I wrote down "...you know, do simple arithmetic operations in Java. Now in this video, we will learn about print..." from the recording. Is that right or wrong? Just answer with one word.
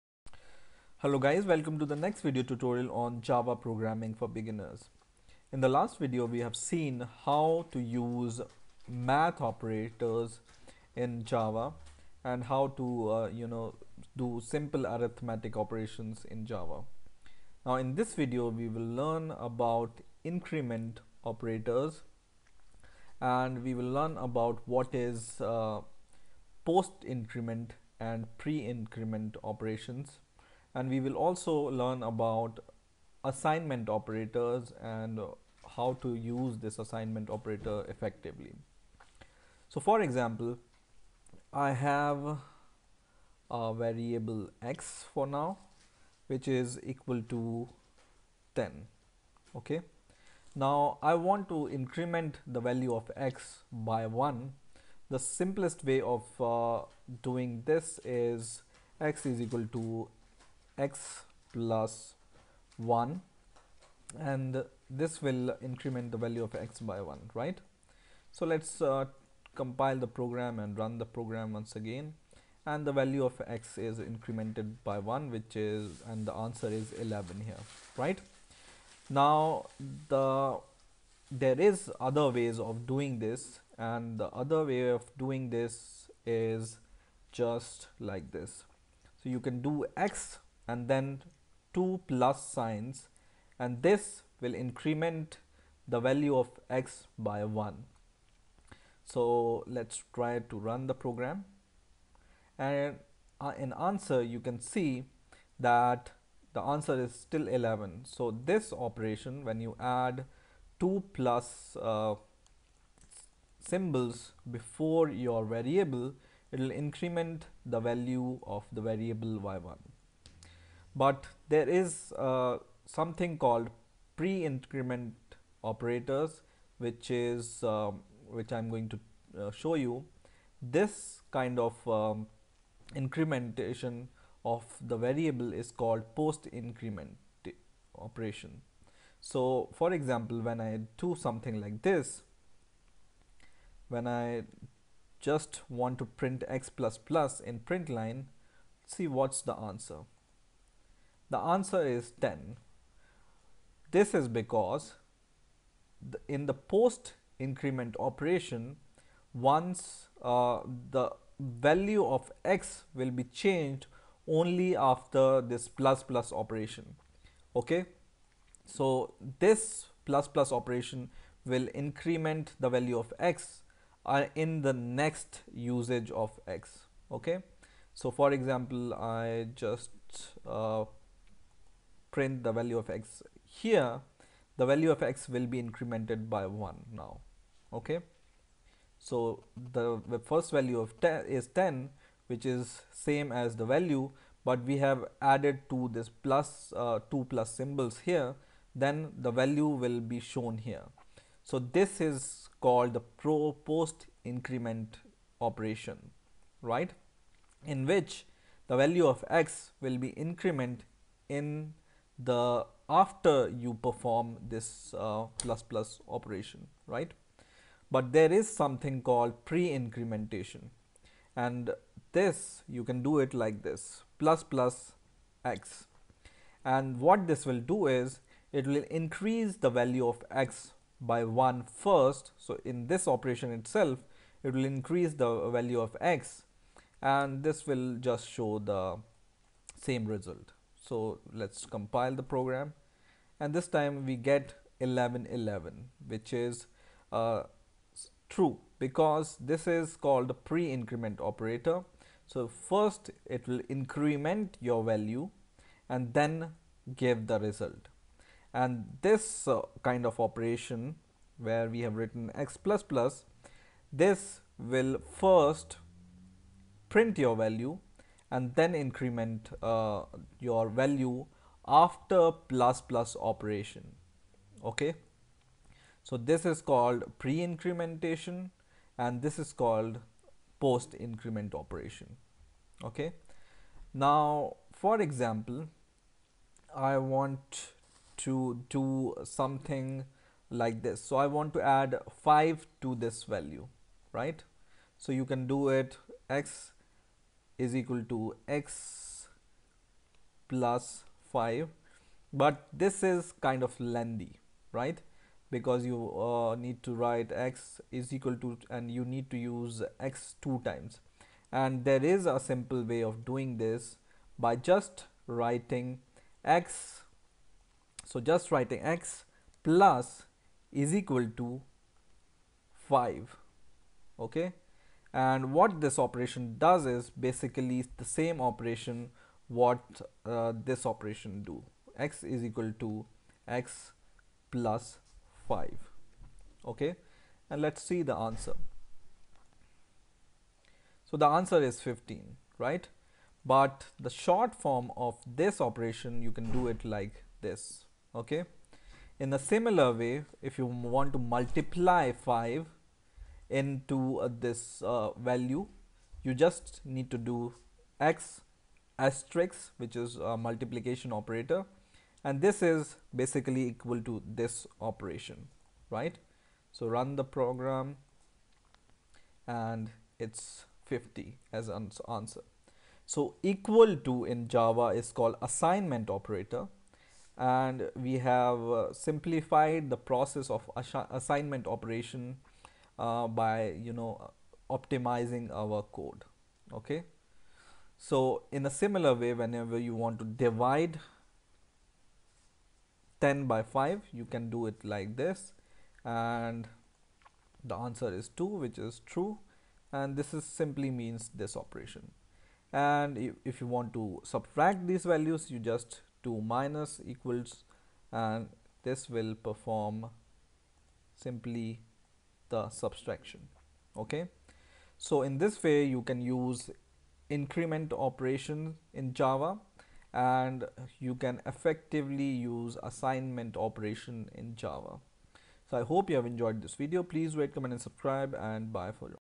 wrong.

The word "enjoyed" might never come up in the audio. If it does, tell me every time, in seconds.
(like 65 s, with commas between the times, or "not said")
426 s.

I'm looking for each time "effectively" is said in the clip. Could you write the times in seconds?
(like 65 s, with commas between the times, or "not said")
37 s, 421 s.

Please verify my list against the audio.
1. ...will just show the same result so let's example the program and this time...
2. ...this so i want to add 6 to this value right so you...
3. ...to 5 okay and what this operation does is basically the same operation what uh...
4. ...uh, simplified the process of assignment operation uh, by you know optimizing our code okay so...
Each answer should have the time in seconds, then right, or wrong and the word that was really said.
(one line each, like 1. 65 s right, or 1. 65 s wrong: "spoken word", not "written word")
1. 237 s wrong: "compile", not "example"
2. 290 s wrong: "5", not "6"
3. 321 s right
4. 378 s right.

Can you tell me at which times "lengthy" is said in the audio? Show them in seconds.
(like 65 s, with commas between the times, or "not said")
303 s.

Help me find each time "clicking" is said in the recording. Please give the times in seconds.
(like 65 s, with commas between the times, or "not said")
not said.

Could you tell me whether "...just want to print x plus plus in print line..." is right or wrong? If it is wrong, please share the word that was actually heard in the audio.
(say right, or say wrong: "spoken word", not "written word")
right.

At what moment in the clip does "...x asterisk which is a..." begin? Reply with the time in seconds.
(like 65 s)
357 s.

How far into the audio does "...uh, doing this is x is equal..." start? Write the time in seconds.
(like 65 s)
56 s.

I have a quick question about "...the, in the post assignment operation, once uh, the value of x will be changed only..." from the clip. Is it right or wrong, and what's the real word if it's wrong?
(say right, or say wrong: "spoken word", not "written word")
wrong: "increment", not "assignment".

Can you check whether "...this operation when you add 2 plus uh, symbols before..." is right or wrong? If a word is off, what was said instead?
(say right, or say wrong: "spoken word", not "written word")
right.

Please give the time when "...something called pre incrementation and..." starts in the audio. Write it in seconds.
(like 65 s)
218 s.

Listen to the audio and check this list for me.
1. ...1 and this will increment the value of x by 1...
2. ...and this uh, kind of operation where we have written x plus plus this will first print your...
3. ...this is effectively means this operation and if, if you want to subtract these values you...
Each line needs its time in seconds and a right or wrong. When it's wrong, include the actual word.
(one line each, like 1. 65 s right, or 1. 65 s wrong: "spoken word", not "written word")
1. 62 s right
2. 258 s right
3. 400 s wrong: "simply", not "effectively".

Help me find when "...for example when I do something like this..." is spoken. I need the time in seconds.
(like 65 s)
139 s.